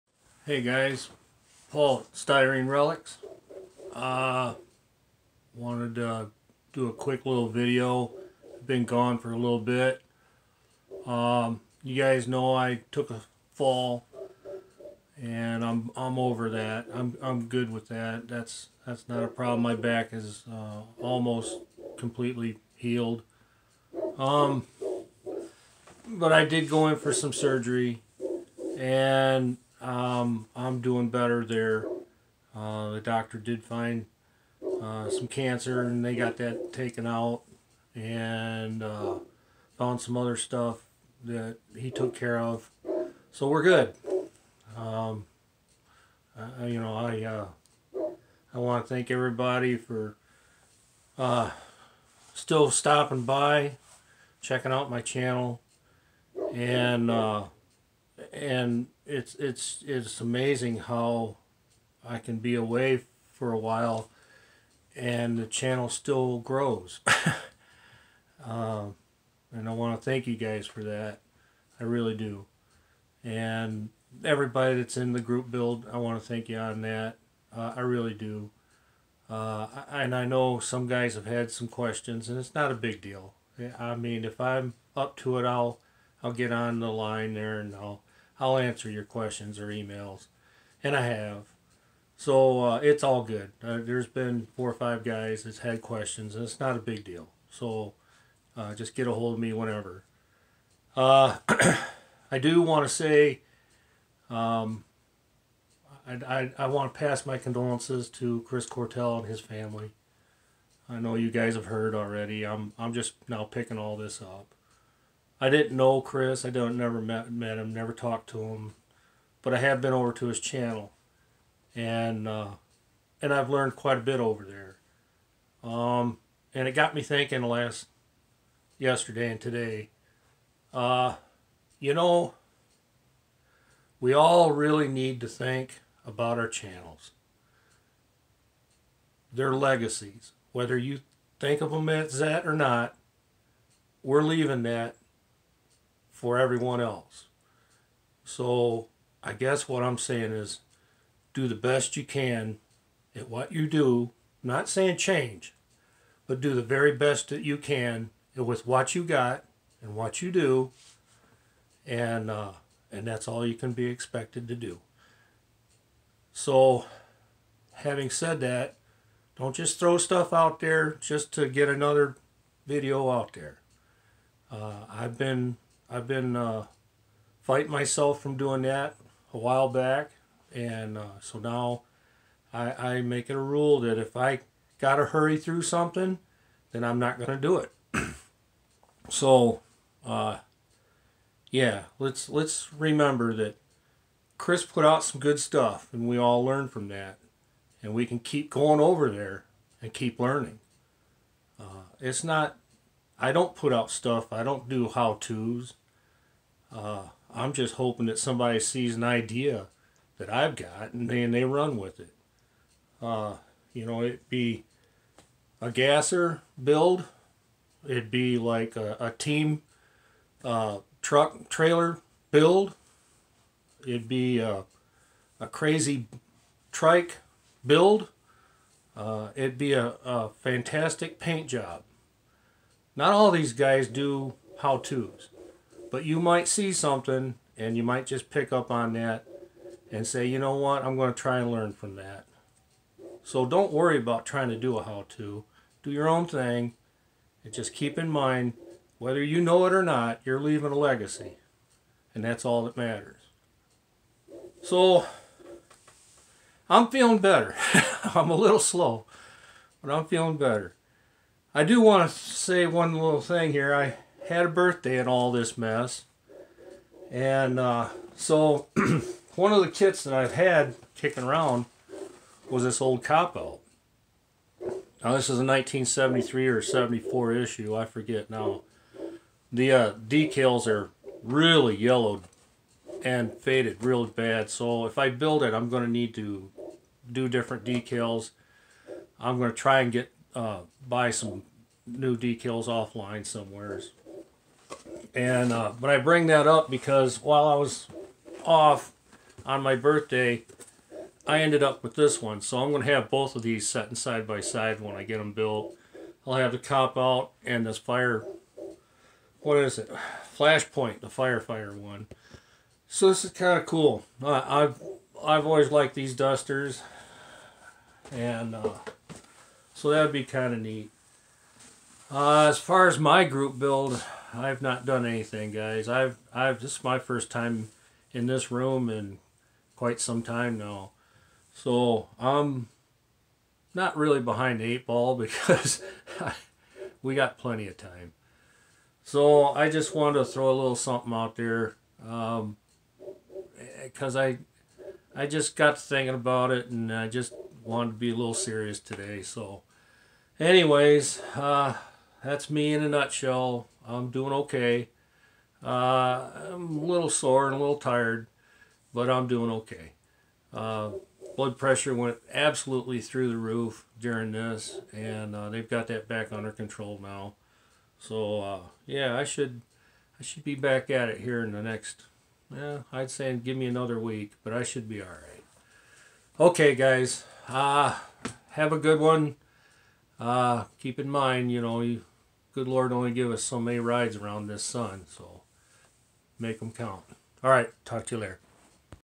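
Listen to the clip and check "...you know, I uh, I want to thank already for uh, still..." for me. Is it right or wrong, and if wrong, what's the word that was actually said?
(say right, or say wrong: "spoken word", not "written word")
wrong: "everybody", not "already".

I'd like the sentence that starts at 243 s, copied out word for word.
So don't worry about trying to do a how-to.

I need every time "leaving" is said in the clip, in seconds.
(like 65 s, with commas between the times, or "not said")
144 s, 250 s.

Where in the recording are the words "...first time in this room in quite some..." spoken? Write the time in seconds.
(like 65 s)
326 s.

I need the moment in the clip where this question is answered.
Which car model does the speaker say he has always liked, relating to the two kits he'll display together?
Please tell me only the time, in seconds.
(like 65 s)
316 s.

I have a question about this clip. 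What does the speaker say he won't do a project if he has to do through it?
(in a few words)
hurry.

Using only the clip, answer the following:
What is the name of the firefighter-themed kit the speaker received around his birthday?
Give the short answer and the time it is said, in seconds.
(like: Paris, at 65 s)
Flashpoint, at 310 s.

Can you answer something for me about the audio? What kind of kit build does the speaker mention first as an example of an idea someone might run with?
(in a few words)
gasser build.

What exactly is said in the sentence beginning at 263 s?
I had a birthday and all this mess.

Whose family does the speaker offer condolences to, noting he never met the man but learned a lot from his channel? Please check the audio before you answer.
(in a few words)
Chris Cortell.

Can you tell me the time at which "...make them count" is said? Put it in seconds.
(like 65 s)
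386 s.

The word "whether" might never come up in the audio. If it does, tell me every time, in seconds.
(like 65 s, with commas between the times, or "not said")
140 s, 248 s.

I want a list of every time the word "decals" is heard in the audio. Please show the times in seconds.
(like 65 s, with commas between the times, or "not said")
279 s, 287 s, 292 s.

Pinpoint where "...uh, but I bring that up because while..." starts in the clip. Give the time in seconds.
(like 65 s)
295 s.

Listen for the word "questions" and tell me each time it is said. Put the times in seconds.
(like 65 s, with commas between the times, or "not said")
81 s, 89 s, 95 s.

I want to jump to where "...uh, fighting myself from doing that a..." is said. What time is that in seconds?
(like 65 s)
176 s.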